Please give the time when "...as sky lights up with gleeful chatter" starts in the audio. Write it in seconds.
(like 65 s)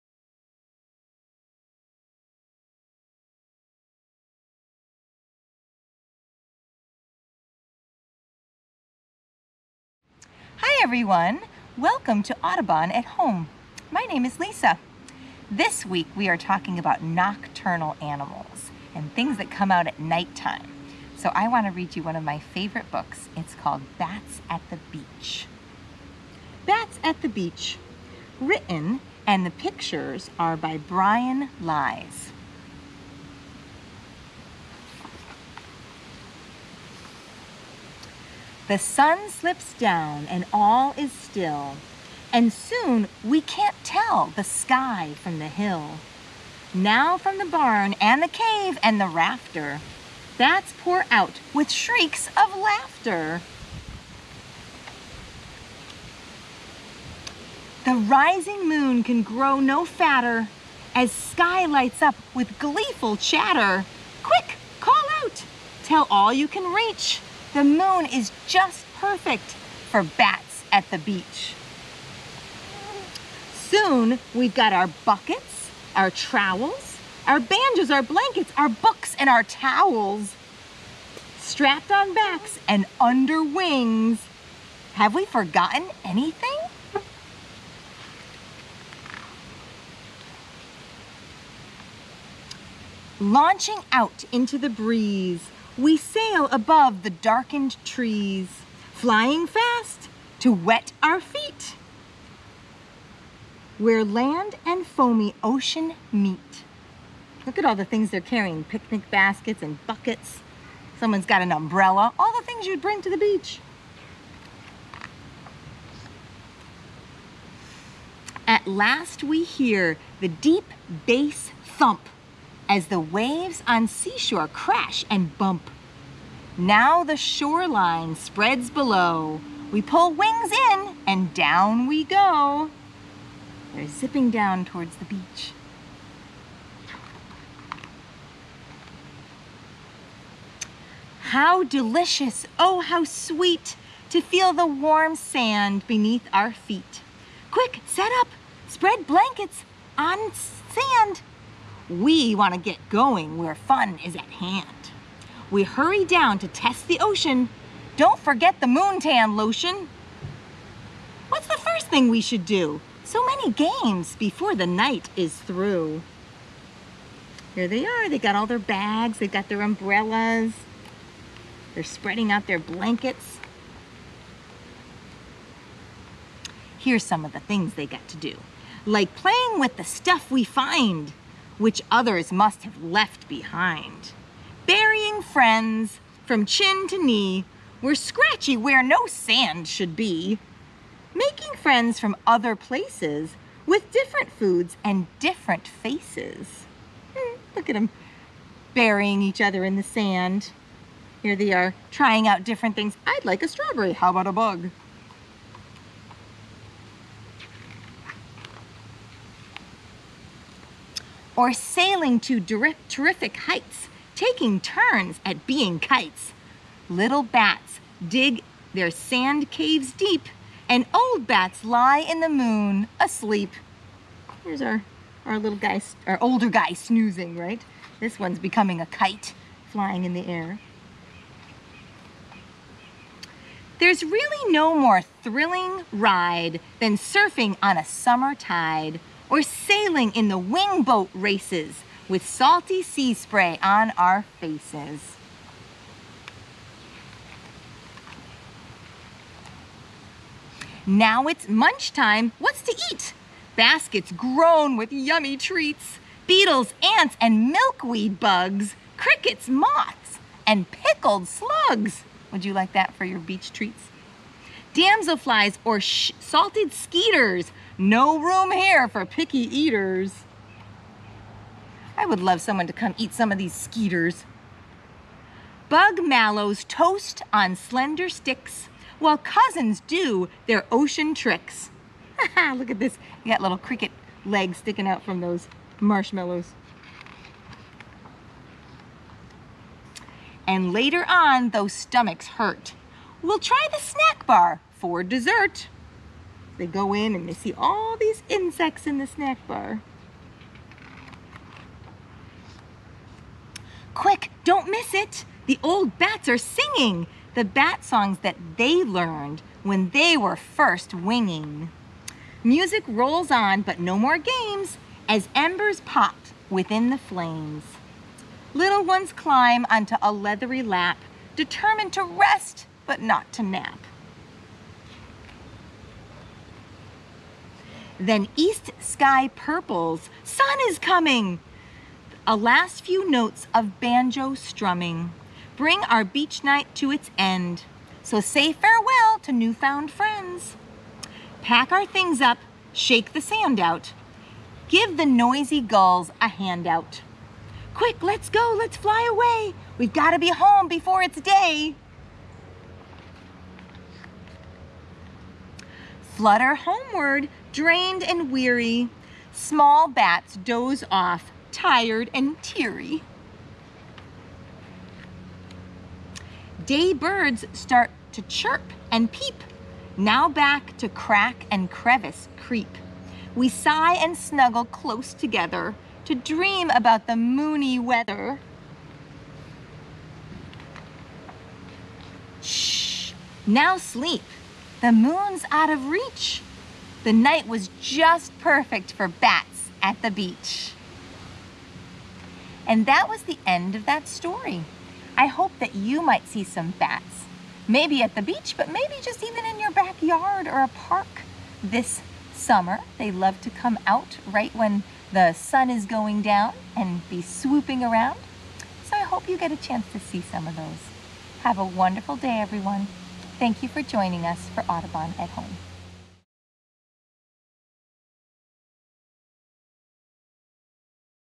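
60 s.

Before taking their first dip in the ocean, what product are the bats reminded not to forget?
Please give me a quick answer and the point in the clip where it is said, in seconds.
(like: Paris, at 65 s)
moontan lotion, at 158 s.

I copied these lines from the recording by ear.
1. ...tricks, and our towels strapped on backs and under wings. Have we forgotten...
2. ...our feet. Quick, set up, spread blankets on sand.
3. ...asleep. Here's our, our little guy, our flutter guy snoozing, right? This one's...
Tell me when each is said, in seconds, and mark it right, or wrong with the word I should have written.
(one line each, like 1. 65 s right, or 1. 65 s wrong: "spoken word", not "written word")
1. 78 s wrong: "books", not "tricks"
2. 146 s right
3. 222 s wrong: "older", not "flutter".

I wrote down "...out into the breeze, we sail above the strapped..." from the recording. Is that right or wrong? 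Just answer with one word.
wrong.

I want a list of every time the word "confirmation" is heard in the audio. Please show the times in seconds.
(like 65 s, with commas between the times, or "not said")
not said.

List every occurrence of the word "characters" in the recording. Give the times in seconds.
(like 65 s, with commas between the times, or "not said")
not said.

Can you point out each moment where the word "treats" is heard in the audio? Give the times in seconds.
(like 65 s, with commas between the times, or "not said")
255 s, 263 s.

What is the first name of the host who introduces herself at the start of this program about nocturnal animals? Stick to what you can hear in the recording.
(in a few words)
Lisa.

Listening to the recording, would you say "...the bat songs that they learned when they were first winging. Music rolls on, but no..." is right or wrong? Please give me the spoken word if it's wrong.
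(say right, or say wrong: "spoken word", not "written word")
right.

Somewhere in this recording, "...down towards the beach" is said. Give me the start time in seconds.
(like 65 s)
134 s.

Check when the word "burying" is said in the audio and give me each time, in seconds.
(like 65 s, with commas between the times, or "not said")
184 s, 198 s.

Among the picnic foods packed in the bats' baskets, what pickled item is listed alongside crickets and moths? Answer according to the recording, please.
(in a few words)
pickled slugs.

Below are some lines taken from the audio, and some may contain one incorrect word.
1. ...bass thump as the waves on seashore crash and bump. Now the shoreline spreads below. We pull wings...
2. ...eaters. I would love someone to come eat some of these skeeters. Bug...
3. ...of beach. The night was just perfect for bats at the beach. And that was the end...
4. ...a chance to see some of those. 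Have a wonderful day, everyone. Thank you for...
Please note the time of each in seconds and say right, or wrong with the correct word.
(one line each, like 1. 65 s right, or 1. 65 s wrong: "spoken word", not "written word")
1. 121 s right
2. 269 s right
3. 385 s wrong: "reach", not "beach"
4. 409 s right.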